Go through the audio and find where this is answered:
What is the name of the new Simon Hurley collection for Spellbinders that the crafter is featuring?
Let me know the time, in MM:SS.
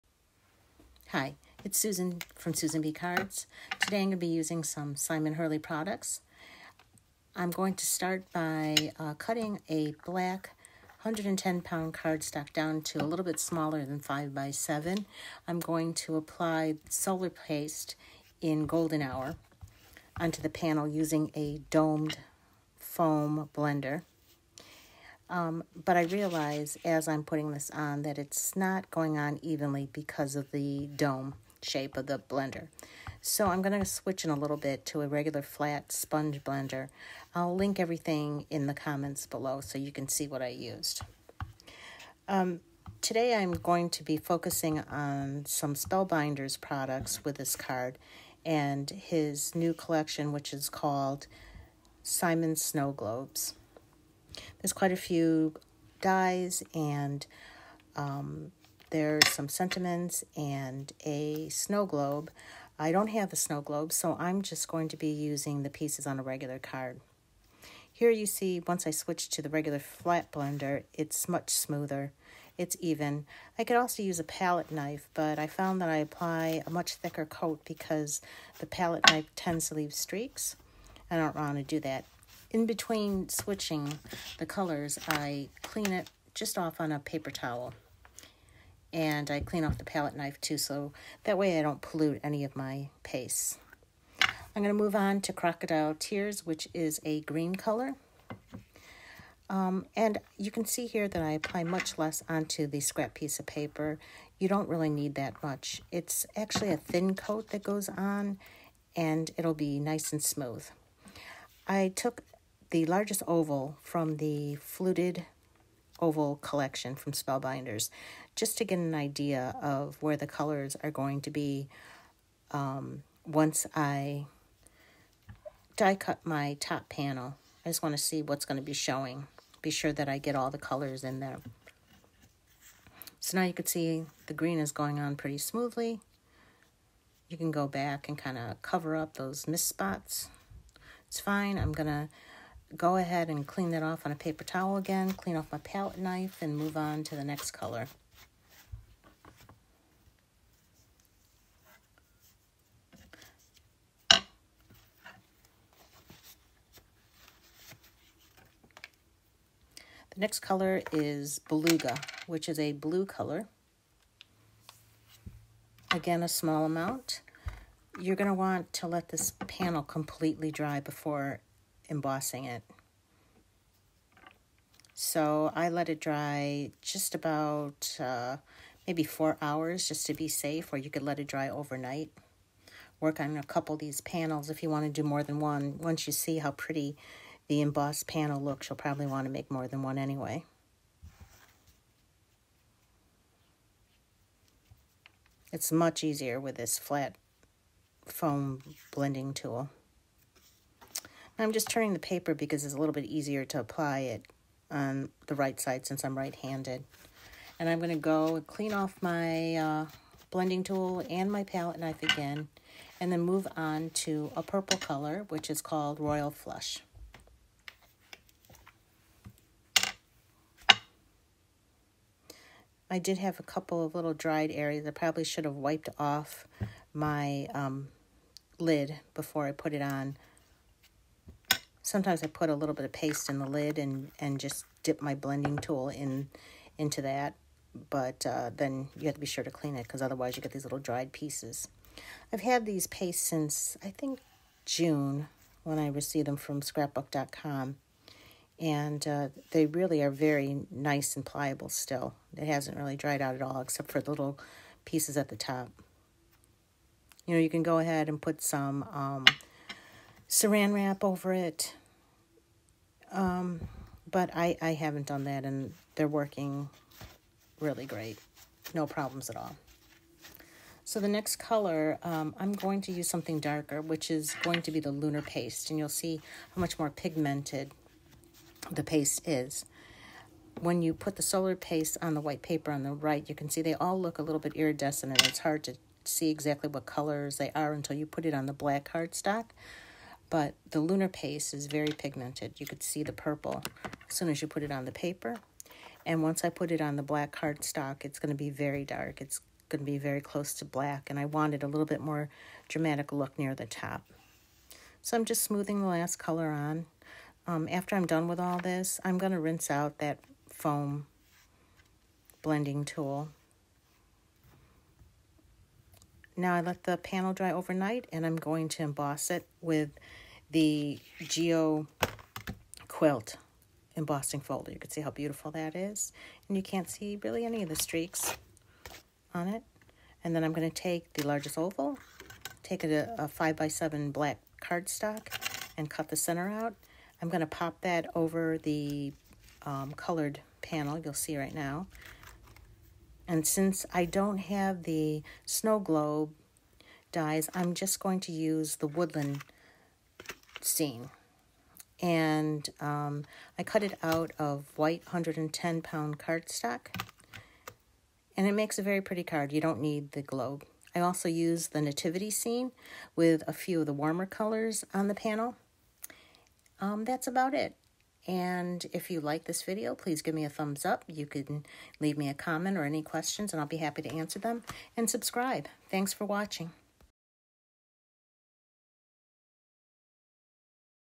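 00:52.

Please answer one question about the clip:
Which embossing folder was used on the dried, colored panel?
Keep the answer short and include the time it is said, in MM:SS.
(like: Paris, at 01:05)
Geo Quilt, at 05:21.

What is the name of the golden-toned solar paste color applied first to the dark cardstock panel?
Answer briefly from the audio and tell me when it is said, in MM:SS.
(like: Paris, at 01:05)
Golden Hour, at 00:18.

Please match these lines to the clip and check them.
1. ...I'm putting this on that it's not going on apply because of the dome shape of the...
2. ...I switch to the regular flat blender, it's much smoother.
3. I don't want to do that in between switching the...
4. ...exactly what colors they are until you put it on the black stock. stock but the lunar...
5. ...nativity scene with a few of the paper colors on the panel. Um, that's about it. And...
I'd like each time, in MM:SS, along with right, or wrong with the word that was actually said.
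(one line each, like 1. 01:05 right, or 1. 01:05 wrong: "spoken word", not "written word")
1. 00:27 wrong: "evenly", not "apply"
2. 01:08 right
3. 01:21 right
4. 04:46 wrong: "cardstock", not "stock"
5. 06:01 wrong: "warmer", not "paper".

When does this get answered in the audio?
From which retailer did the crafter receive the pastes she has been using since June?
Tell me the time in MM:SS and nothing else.
04:06.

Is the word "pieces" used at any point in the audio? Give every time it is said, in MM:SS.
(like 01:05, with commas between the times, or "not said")
01:05, 01:43, 04:01, 04:14.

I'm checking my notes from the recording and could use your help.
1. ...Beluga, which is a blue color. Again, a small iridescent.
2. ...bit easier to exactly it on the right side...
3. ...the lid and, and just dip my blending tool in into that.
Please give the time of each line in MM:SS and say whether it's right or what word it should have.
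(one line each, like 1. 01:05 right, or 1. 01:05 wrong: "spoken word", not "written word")
1. 02:41 wrong: "amount", not "iridescent"
2. 03:22 wrong: "apply", not "exactly"
3. 03:53 right.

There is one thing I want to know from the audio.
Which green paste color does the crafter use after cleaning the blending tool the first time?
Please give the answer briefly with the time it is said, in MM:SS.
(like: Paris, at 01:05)
Crocodile Tears, at 01:35.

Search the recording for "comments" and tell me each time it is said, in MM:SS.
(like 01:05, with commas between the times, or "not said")
00:38, 06:12.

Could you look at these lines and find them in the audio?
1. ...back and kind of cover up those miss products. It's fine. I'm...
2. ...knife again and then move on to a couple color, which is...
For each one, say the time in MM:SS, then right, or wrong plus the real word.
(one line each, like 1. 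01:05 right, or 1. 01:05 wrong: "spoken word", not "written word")
1. 02:17 wrong: "spots", not "products"
2. 03:31 wrong: "purple", not "couple".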